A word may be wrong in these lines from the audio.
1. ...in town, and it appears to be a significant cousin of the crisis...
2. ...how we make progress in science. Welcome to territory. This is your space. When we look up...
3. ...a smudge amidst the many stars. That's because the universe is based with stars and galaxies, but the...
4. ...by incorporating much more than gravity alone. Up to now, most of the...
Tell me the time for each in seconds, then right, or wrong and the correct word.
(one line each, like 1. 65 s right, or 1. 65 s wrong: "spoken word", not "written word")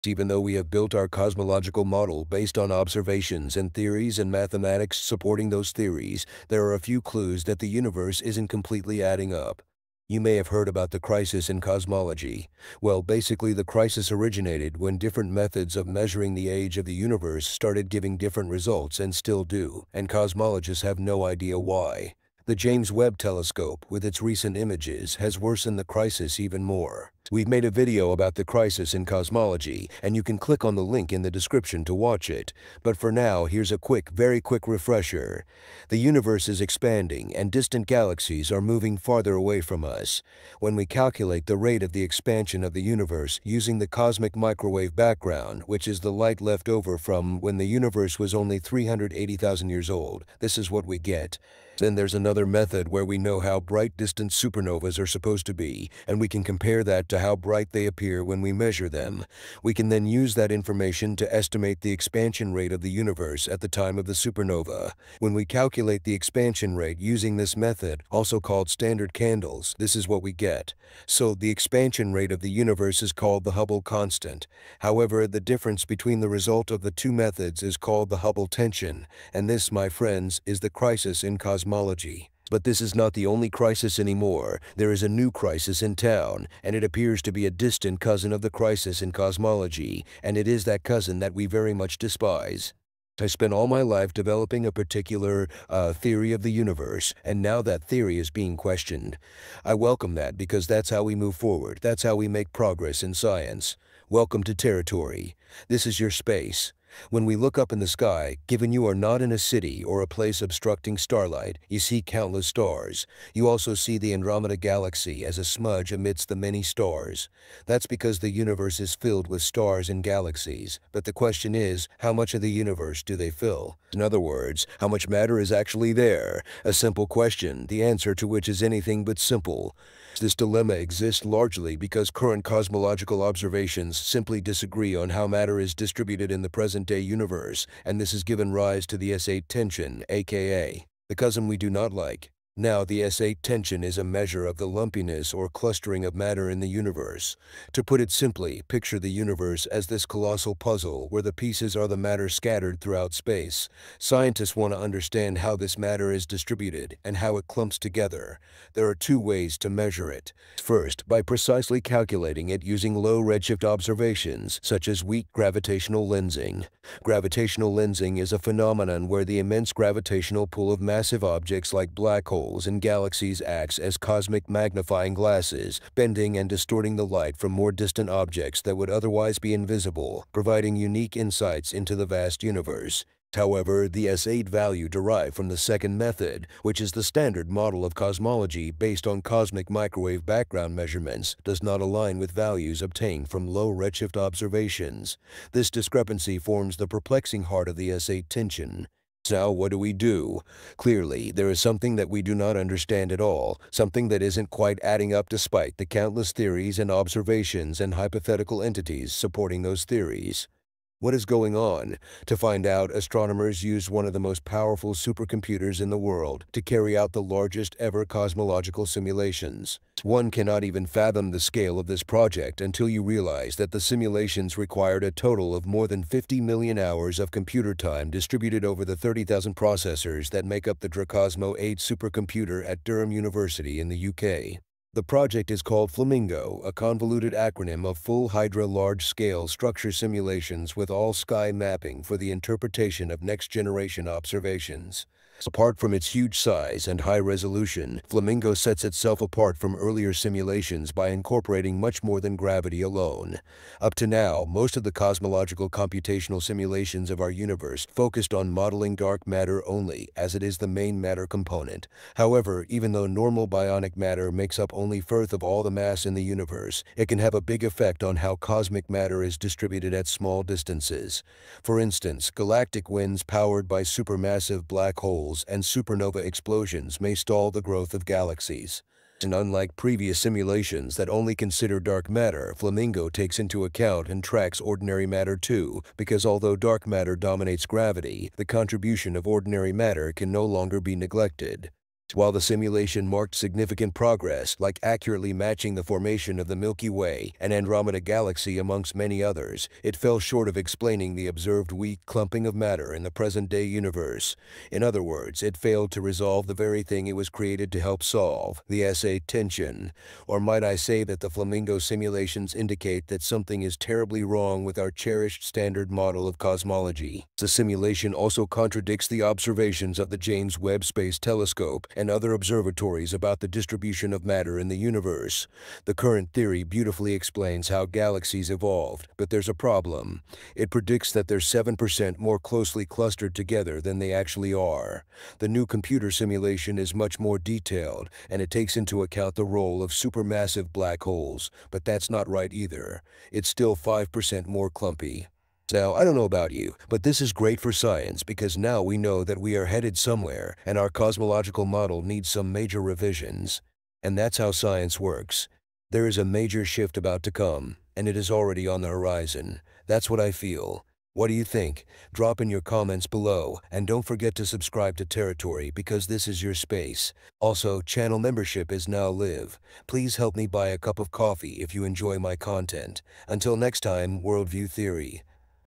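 1. 85 s wrong: "distant", not "significant"
2. 102 s right
3. 115 s wrong: "filled", not "based"
4. 250 s right.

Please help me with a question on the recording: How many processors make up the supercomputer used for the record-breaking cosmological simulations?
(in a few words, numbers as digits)
30,000.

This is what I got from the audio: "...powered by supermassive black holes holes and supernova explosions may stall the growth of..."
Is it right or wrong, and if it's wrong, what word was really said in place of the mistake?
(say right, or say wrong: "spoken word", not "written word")
right.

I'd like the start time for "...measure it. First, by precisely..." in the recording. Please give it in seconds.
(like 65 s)
159 s.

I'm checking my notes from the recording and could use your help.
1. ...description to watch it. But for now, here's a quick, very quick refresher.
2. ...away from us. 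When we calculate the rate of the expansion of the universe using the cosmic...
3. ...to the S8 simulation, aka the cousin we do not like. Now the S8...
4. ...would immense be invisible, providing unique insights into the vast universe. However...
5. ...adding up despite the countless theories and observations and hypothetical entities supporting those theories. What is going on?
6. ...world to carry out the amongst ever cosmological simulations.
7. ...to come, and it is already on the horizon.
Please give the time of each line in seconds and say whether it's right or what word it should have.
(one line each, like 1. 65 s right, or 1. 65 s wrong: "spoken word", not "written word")
1. 31 s right
2. 39 s right
3. 138 s wrong: "tension", not "simulation"
4. 178 s wrong: "otherwise", not "immense"
5. 204 s right
6. 215 s wrong: "largest", not "amongst"
7. 357 s right.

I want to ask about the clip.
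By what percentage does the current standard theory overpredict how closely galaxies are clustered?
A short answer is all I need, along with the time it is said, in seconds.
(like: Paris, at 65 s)
7%, at 331 s.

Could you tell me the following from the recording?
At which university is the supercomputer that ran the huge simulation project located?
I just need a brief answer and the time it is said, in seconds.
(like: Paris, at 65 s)
Durham University, at 232 s.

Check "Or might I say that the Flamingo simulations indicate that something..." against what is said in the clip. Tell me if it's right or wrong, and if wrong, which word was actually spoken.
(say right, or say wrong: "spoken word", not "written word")
right.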